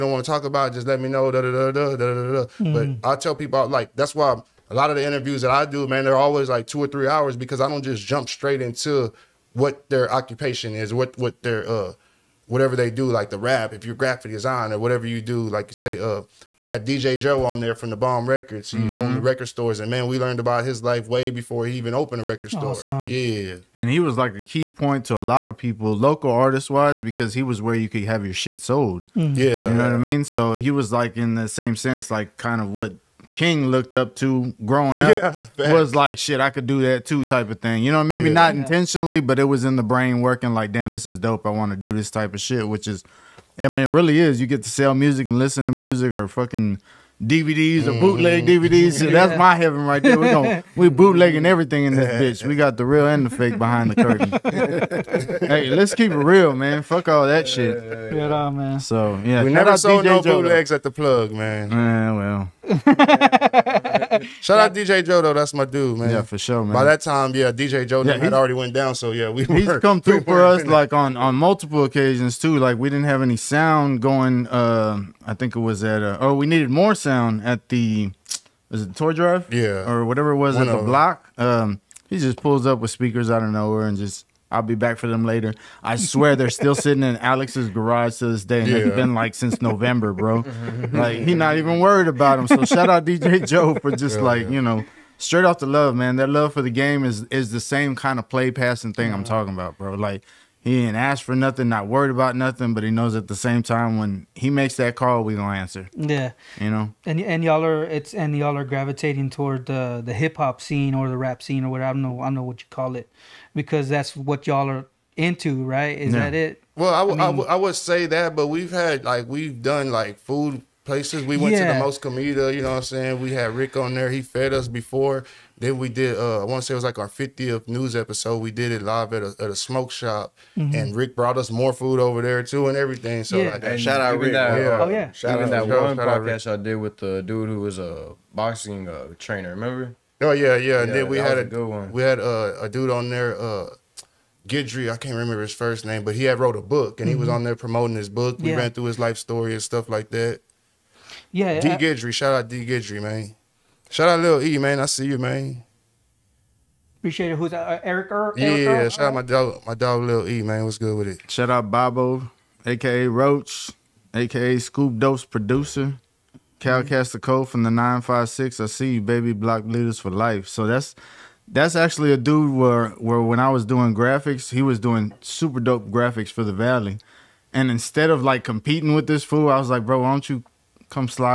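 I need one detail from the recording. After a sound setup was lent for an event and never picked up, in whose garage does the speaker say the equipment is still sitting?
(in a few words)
Alex's garage.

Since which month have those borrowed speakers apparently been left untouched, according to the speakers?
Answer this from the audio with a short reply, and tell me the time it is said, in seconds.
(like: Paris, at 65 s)
November, at 89 s.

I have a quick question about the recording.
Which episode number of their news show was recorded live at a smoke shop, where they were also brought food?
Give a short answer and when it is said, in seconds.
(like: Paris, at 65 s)
50th, at 127 s.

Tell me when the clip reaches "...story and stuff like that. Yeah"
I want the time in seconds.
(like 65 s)
149 s.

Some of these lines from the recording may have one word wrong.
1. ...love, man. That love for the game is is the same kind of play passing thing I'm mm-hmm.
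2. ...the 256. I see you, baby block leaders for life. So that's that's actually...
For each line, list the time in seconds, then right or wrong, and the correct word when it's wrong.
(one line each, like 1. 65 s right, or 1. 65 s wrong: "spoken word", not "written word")
1. 95 s right
2. 167 s wrong: "956", not "256".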